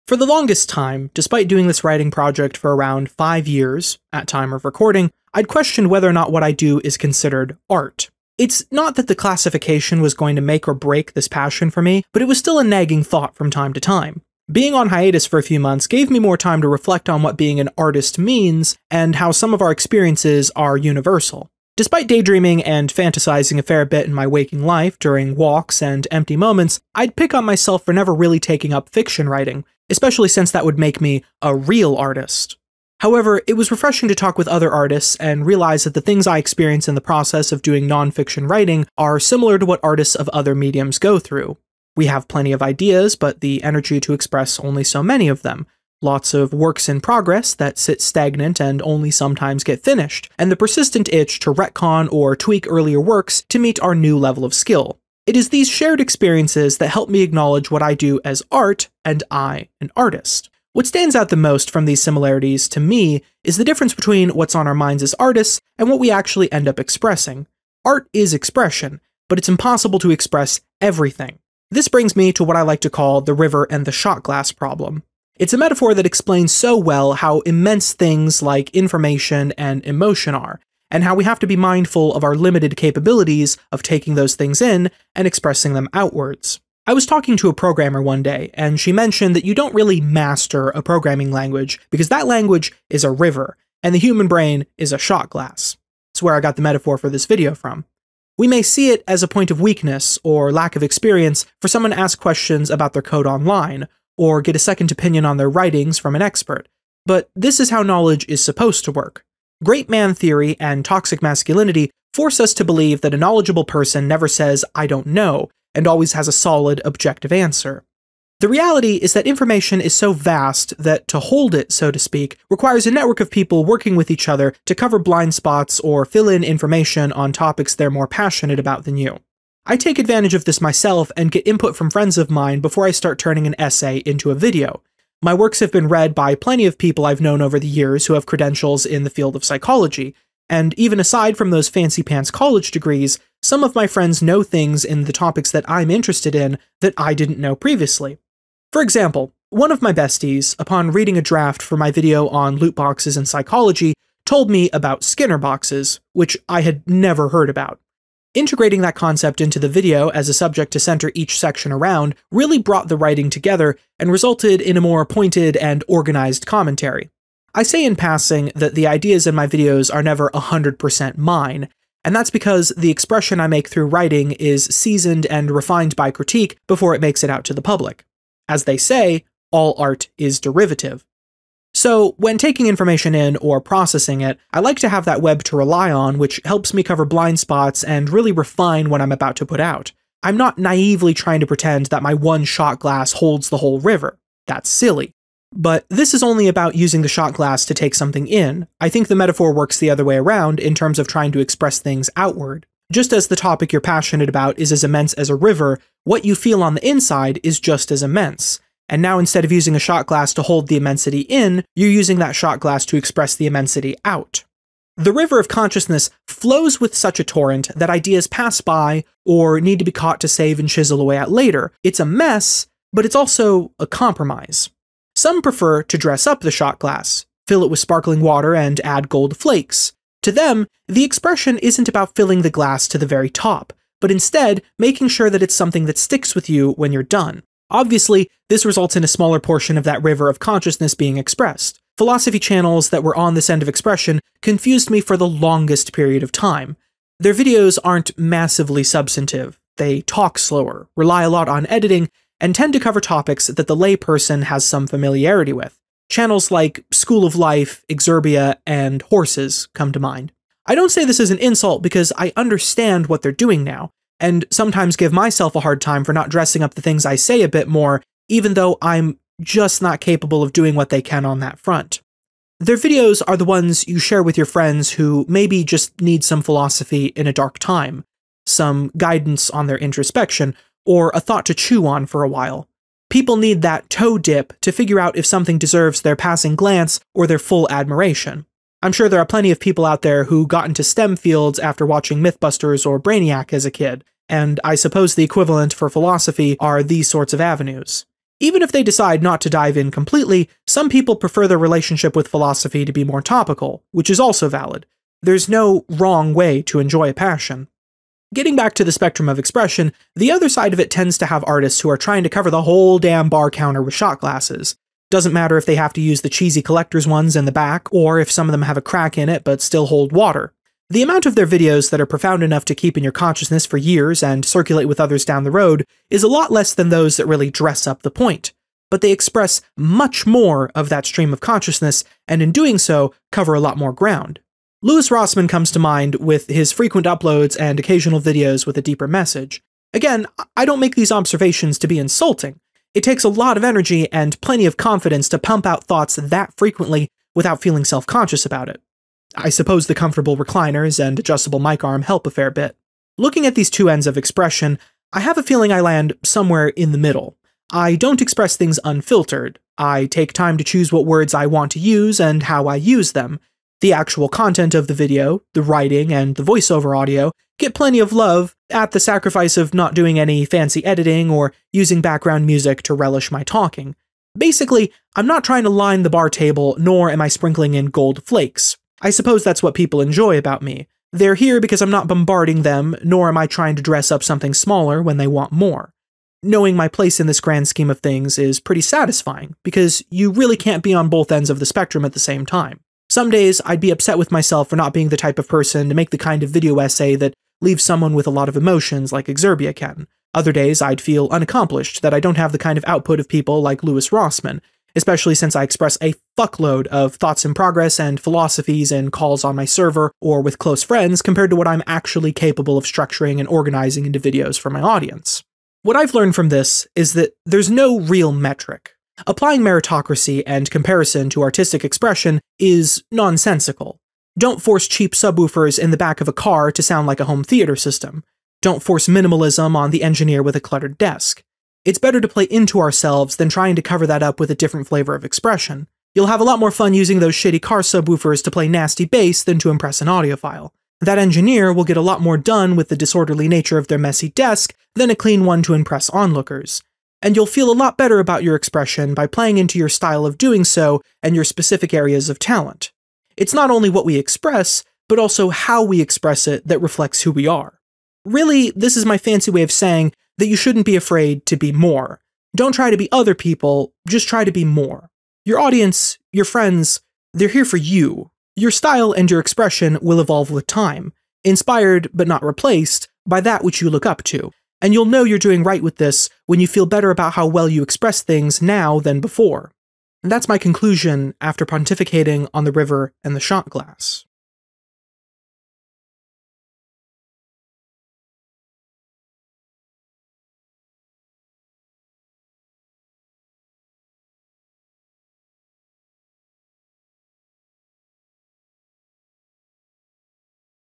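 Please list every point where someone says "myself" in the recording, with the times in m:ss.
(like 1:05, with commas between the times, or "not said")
0:27, 2:10, 4:25, 6:34.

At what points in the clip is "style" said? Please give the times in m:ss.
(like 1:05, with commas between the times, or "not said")
7:29, 7:48.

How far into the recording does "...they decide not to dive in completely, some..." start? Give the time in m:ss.
4:58.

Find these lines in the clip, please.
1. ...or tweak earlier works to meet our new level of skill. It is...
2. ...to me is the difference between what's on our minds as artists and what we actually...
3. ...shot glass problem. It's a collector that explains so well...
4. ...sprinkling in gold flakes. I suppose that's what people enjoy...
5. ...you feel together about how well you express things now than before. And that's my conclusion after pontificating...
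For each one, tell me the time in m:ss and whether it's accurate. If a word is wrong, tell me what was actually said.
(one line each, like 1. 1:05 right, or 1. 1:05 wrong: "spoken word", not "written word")
1. 0:52 right
2. 1:02 right
3. 1:13 wrong: "metaphor", not "collector"
4. 6:17 right
5. 7:56 wrong: "better", not "together".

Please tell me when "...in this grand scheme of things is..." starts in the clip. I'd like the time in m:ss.
6:27.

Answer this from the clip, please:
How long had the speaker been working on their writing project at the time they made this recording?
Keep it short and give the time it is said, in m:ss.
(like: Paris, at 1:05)
5 years, at 0:03.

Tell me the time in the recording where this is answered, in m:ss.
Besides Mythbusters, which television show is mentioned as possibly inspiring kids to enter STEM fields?
4:52.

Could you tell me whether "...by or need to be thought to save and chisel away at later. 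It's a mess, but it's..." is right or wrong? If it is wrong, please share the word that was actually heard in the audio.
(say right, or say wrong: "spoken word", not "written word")
wrong: "caught", not "thought".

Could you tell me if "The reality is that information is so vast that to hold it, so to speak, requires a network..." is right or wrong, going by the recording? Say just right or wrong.
right.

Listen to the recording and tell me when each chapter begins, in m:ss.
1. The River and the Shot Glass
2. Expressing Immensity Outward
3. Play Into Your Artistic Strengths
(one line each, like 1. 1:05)
1. 1:00
2. 3:18
3. 6:18.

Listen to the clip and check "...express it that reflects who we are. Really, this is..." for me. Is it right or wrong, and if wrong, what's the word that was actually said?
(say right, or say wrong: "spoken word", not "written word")
right.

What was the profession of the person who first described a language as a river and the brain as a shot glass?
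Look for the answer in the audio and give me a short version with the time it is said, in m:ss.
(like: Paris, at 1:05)
programmer, at 1:27.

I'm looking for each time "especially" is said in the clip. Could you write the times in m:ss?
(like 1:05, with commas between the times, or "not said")
0:29, 6:44.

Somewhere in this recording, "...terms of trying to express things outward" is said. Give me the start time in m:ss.
3:20.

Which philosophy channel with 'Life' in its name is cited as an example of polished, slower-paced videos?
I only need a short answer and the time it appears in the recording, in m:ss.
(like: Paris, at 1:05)
School of Life, at 4:16.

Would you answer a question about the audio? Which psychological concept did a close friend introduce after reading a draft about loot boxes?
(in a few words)
Skinner boxes.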